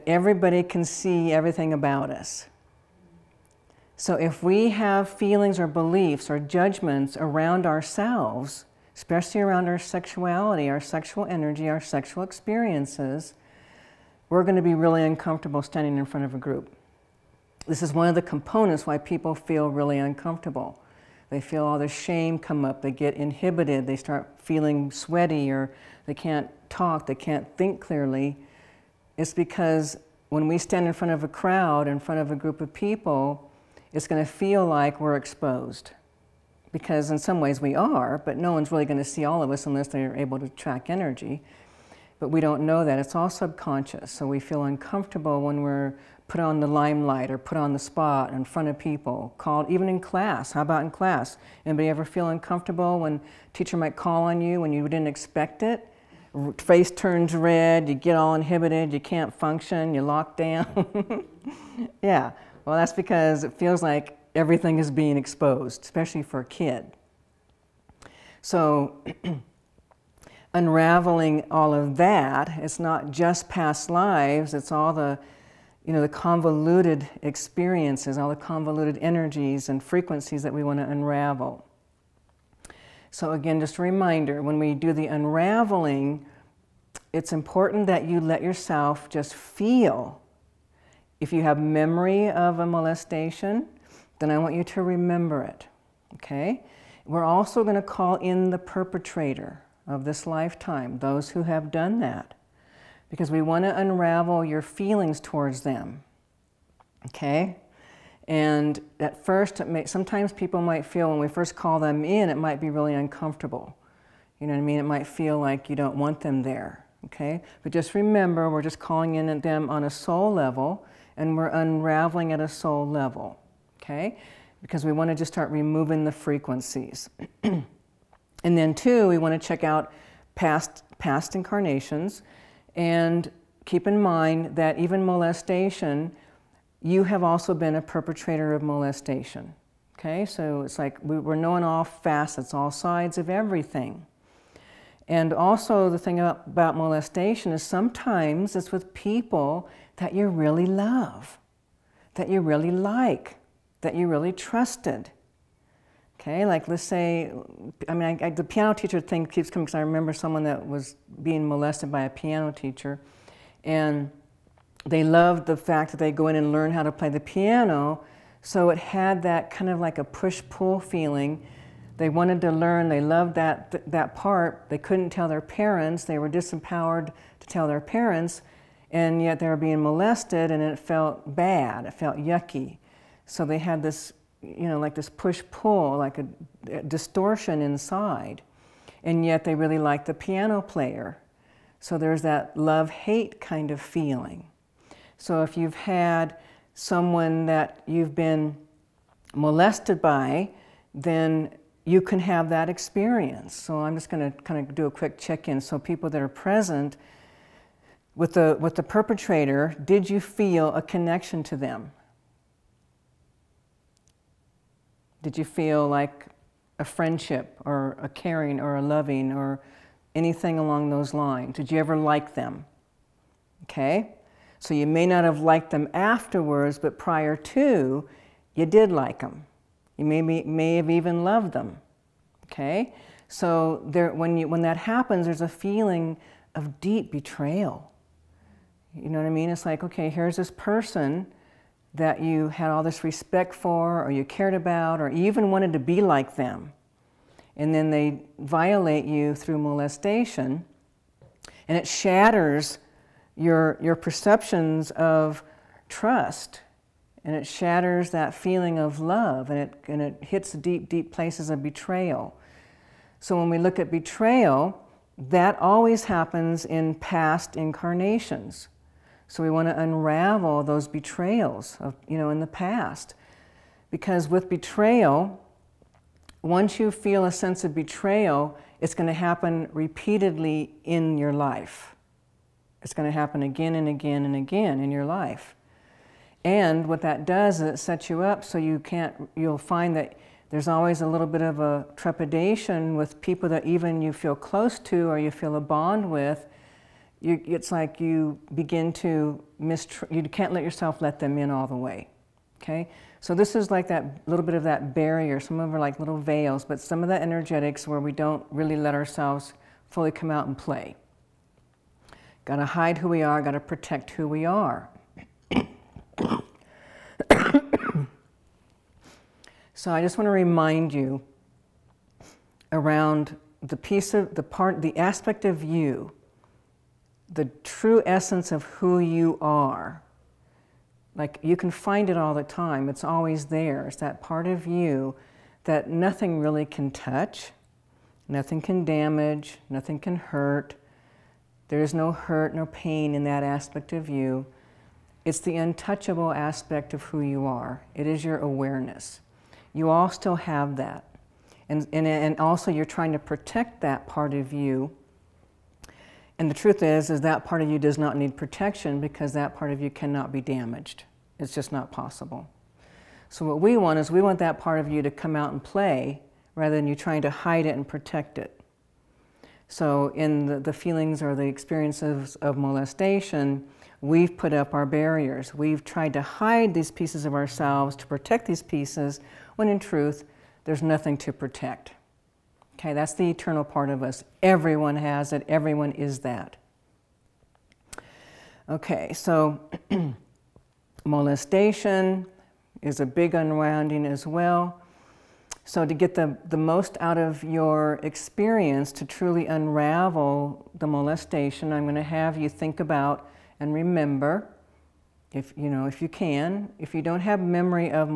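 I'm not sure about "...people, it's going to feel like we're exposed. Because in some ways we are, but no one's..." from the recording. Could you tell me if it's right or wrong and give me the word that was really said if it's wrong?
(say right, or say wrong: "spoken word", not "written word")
right.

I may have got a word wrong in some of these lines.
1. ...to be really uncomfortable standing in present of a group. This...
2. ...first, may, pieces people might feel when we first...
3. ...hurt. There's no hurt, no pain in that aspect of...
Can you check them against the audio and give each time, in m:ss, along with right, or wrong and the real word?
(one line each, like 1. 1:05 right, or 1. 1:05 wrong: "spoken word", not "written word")
1. 0:14 wrong: "front", not "present"
2. 1:49 wrong: "sometimes", not "pieces"
3. 5:40 right.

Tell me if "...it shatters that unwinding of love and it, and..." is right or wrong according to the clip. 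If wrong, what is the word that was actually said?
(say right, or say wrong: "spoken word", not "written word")
wrong: "feeling", not "unwinding".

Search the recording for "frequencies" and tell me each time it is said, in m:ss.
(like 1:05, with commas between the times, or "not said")
1:19, 2:06.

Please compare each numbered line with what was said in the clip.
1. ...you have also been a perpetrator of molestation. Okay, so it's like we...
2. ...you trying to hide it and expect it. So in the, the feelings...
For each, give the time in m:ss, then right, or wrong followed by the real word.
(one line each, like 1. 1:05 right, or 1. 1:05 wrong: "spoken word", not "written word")
1. 2:16 right
2. 6:06 wrong: "protect", not "expect".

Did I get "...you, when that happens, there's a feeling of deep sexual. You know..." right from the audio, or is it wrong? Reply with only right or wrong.
wrong.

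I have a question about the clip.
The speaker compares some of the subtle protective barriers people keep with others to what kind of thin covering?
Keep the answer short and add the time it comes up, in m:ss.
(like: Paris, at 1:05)
little veils, at 5:05.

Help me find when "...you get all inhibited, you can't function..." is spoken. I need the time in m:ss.
0:57.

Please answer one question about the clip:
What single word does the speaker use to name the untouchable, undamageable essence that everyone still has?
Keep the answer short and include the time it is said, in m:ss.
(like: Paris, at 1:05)
awareness, at 5:48.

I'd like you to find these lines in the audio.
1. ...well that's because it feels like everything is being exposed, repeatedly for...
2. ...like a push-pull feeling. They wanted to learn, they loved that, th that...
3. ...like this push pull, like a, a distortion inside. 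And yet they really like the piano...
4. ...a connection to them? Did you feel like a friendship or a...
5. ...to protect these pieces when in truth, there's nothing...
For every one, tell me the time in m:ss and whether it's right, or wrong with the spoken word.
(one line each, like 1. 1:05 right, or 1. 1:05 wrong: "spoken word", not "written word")
1. 1:02 wrong: "especially", not "repeatedly"
2. 2:49 right
3. 3:04 right
4. 3:30 right
5. 6:17 right.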